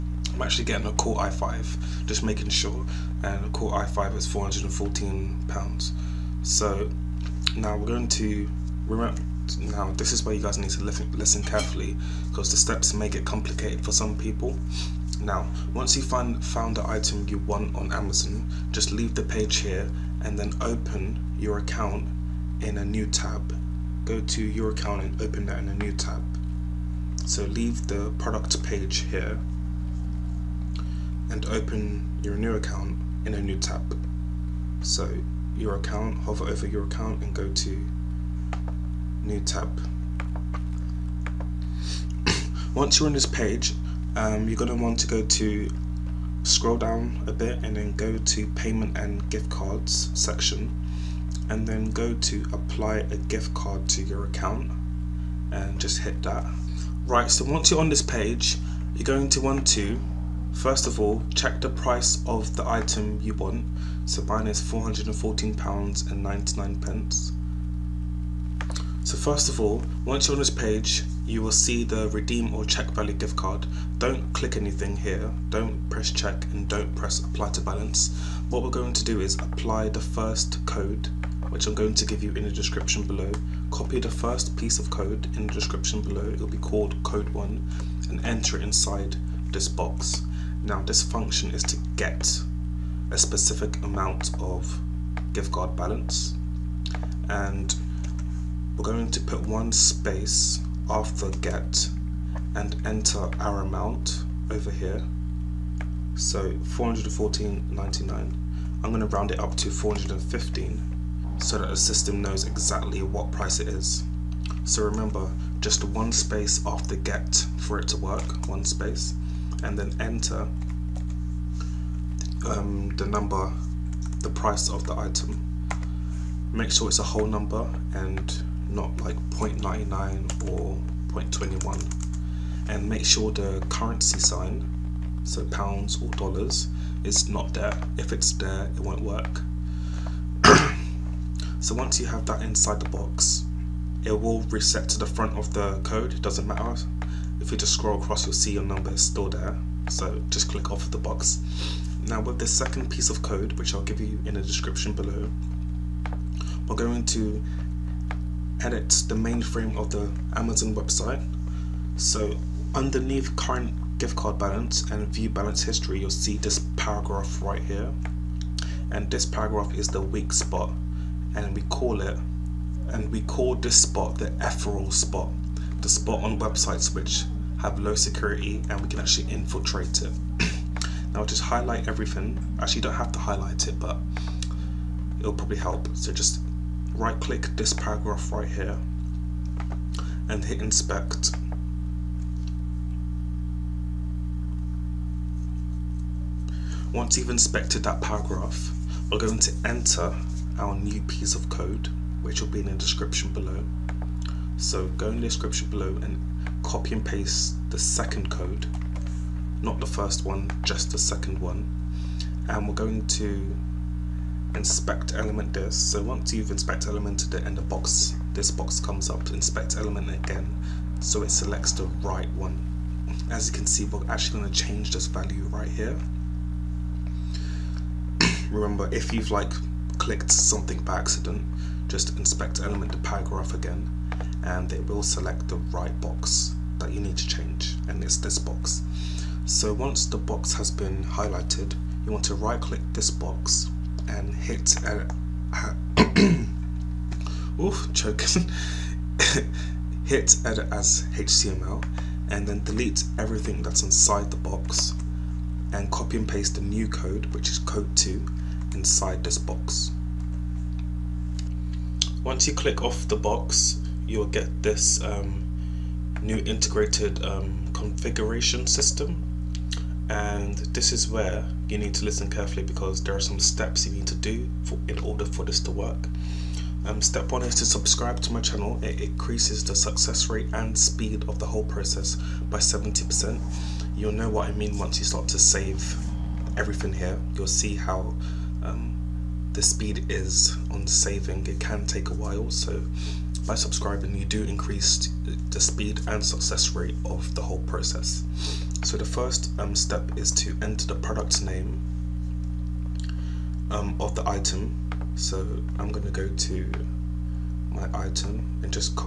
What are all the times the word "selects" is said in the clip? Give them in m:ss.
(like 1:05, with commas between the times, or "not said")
3:41, 3:55.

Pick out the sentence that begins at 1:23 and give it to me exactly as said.
Copy the first piece of code in the description below, it'll be called code 1, and enter it inside this box.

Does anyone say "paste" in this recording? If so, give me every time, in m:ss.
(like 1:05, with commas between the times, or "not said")
3:27, 4:16.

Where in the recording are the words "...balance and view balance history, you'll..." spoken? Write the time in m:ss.
2:44.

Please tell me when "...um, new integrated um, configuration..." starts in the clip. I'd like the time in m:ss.
4:25.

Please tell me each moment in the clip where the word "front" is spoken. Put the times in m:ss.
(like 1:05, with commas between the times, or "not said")
2:25.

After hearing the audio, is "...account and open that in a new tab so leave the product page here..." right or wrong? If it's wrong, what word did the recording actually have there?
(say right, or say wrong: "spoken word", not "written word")
right.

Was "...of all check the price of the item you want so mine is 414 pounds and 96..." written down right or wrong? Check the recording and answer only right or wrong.
wrong.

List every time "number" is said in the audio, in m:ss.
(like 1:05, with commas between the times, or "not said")
2:03, 2:07, 2:28.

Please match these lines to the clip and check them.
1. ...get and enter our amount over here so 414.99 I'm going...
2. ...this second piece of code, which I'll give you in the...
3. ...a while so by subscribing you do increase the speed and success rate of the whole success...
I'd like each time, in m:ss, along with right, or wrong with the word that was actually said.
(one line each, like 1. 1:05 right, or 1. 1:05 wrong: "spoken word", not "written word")
1. 1:41 right
2. 2:32 right
3. 4:52 wrong: "process", not "success".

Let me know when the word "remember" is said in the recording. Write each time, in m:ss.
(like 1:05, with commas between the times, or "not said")
0:08, 1:54, 3:48.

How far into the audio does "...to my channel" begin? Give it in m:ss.
4:38.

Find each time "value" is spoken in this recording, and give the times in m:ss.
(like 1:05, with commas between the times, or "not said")
1:12, 3:45.